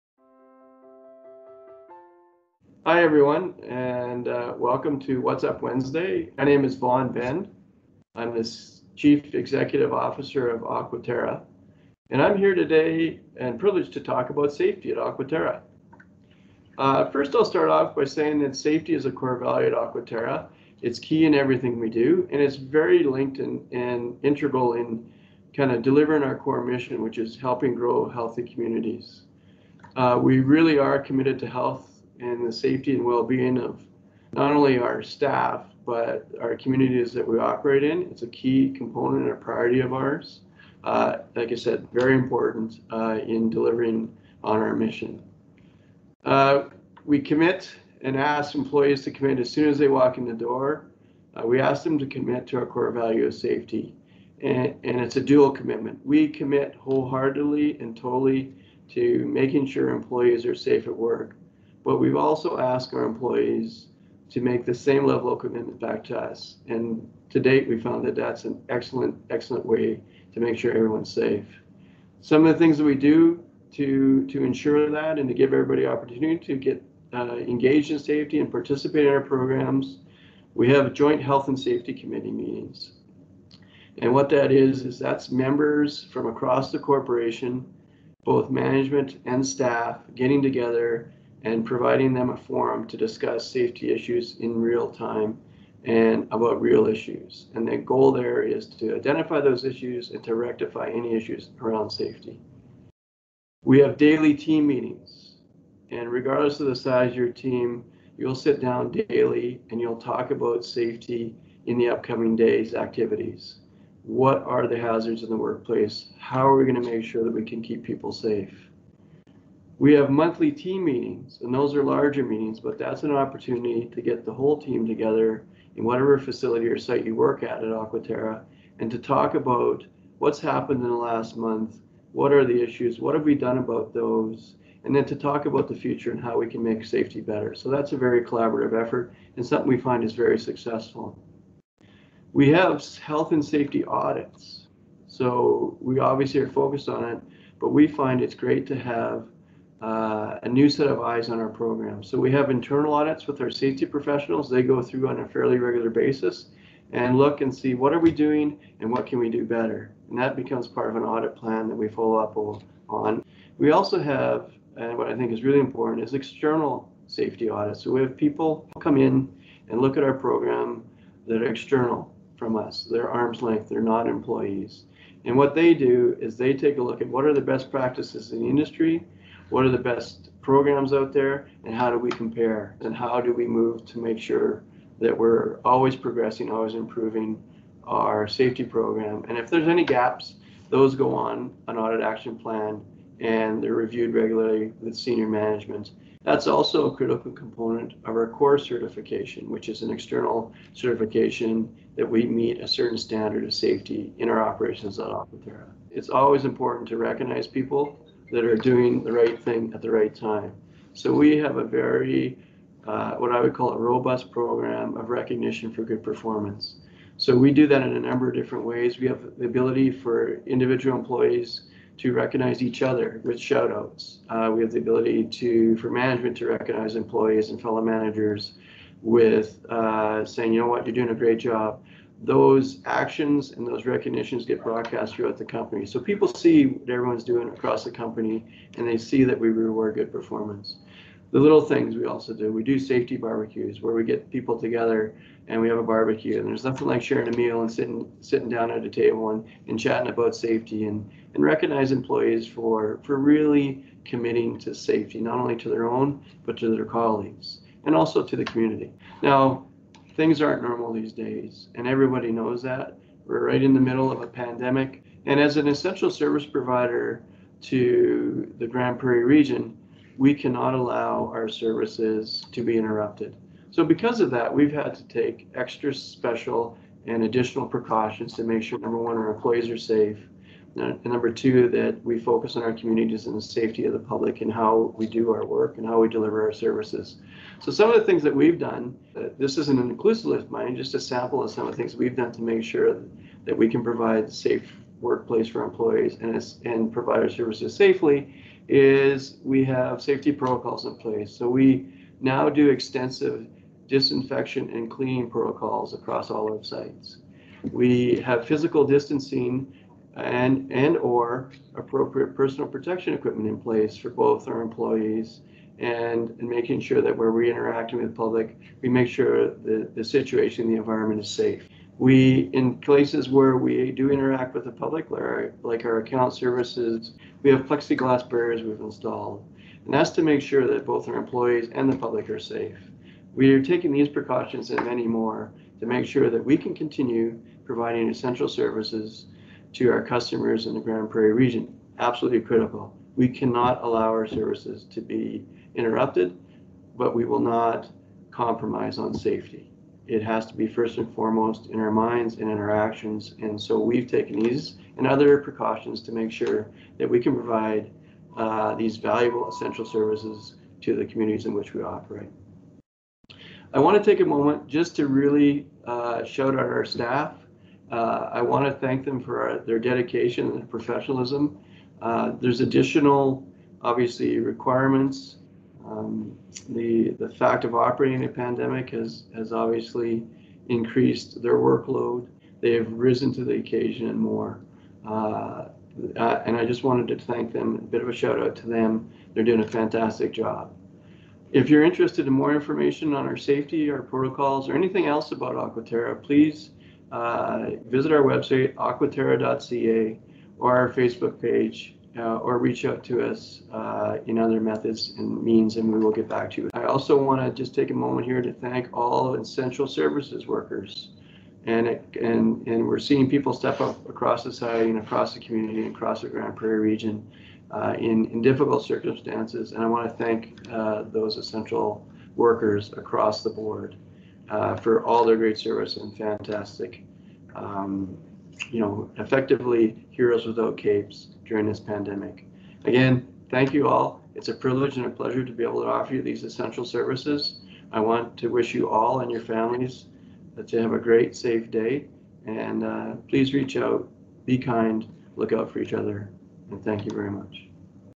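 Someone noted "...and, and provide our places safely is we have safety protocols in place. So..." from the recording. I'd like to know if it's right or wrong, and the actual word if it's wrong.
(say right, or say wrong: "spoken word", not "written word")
wrong: "services", not "places".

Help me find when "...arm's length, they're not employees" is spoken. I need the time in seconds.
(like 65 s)
173 s.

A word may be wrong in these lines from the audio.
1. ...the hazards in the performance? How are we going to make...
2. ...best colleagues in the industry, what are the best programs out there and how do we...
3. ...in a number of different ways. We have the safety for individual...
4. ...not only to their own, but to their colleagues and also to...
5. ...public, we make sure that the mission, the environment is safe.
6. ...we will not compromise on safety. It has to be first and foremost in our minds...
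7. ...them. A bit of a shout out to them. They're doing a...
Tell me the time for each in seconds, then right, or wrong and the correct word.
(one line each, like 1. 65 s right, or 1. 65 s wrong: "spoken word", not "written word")
1. 114 s wrong: "workplace", not "performance"
2. 177 s wrong: "practices", not "colleagues"
3. 217 s wrong: "ability", not "safety"
4. 255 s right
5. 318 s wrong: "situation", not "mission"
6. 347 s right
7. 387 s right.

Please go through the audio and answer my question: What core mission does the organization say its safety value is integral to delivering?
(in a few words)
Helping grow healthy communities.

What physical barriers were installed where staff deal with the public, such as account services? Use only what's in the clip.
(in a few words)
Plexiglass barriers.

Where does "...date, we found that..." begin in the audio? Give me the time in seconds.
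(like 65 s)
67 s.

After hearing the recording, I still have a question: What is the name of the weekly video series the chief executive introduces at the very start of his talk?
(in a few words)
What's Up Wednesday.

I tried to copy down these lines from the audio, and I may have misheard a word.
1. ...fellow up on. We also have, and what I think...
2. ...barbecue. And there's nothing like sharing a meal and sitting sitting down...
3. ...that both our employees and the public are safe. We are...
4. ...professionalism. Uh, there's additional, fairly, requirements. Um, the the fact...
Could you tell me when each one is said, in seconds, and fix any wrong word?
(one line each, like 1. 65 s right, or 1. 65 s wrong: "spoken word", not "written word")
1. 161 s wrong: "follow", not "fellow"
2. 245 s right
3. 330 s right
4. 370 s wrong: "obviously", not "fairly".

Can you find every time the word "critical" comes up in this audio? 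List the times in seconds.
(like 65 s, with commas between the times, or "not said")
196 s, 342 s.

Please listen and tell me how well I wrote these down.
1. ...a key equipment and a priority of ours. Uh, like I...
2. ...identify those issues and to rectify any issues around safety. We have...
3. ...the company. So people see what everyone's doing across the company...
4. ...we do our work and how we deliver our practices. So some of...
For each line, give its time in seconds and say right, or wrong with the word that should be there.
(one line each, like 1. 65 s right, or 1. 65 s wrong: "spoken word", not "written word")
1. 38 s wrong: "component", not "equipment"
2. 98 s right
3. 235 s right
4. 284 s wrong: "services", not "practices".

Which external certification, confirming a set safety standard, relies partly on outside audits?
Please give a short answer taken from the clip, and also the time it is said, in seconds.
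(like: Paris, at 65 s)
COR certification, at 198 s.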